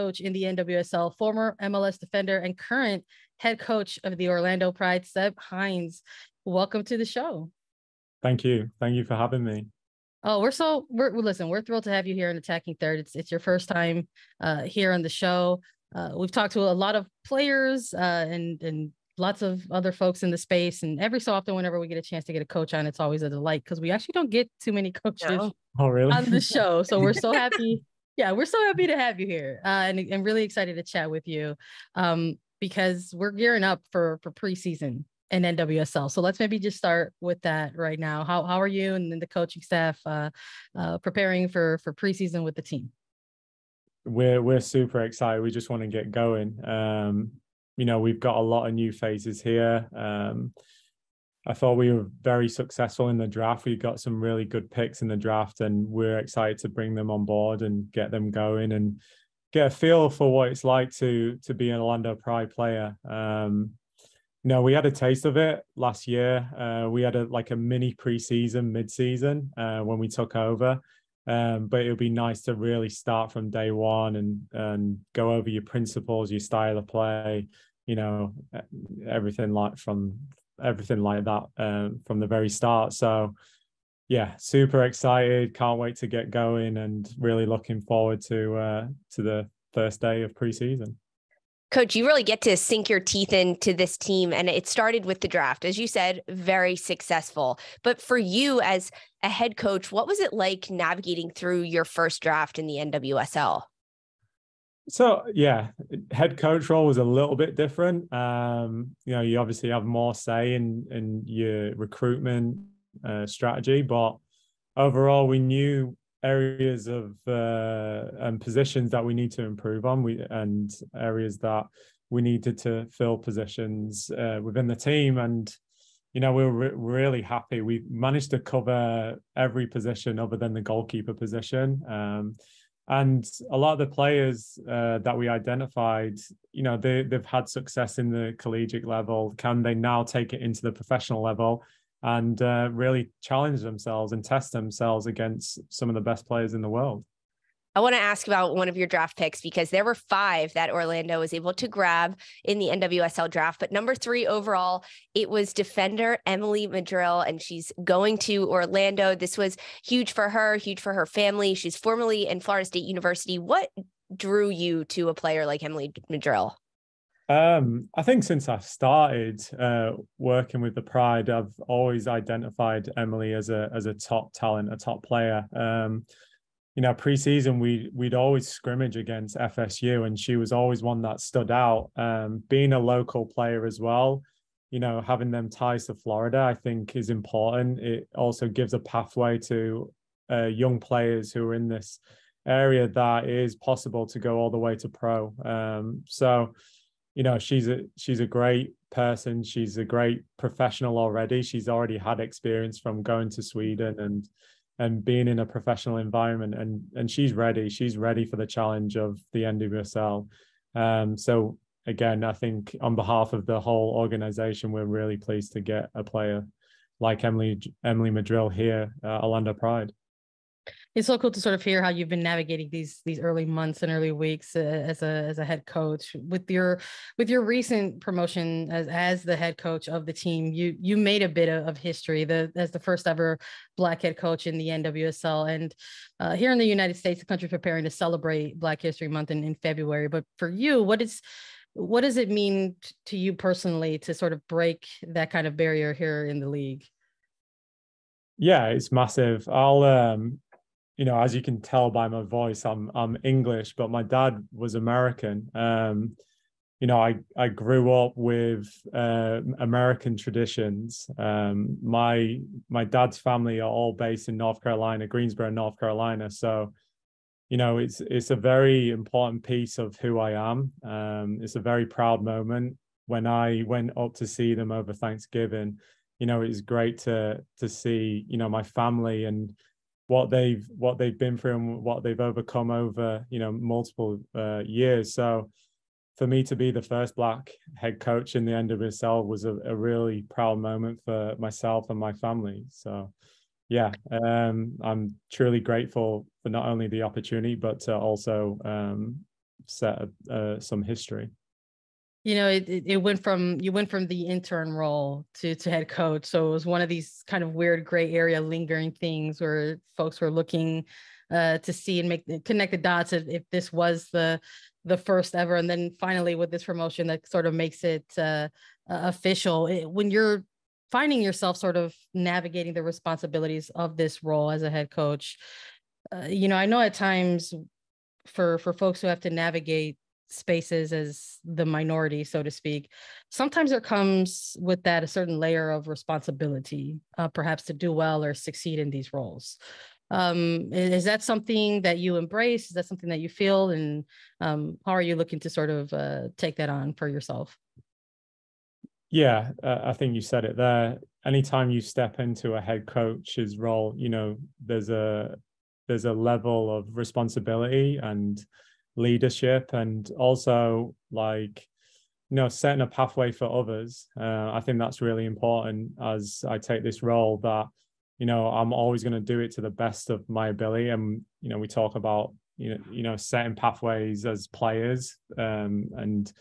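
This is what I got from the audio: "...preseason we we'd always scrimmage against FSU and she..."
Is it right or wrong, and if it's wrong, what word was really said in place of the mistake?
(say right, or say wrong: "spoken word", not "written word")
right.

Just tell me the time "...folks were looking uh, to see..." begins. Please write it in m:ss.
5:09.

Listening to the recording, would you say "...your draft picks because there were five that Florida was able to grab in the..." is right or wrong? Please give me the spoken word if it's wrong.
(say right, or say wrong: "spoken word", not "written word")
wrong: "Orlando", not "Florida".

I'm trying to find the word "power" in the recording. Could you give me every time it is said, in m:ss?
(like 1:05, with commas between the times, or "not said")
not said.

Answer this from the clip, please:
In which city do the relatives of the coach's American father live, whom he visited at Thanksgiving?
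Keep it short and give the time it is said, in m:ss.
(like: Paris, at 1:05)
Greensboro, North Carolina, at 4:25.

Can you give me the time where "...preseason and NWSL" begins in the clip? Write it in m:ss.
0:34.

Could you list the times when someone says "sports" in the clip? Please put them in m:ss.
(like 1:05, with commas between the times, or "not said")
not said.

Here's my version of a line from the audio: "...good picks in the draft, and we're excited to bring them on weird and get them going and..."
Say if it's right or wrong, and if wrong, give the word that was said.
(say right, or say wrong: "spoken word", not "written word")
wrong: "board", not "weird".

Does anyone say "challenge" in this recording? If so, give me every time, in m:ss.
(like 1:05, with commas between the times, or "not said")
2:23, 3:28.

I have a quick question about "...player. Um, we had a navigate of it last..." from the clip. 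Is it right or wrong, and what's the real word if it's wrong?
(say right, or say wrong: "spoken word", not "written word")
wrong: "taste", not "navigate".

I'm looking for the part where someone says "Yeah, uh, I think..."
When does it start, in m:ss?
5:49.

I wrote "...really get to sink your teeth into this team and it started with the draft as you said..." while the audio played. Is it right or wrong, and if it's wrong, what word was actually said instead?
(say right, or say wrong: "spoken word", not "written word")
right.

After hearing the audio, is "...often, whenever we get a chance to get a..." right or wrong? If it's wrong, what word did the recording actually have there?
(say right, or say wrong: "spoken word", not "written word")
right.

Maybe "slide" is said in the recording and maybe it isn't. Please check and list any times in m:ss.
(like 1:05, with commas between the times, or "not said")
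not said.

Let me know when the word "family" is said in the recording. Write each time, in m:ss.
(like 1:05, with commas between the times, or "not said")
2:41, 4:23, 4:38, 4:52.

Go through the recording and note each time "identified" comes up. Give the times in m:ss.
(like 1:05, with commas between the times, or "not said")
2:15, 2:52.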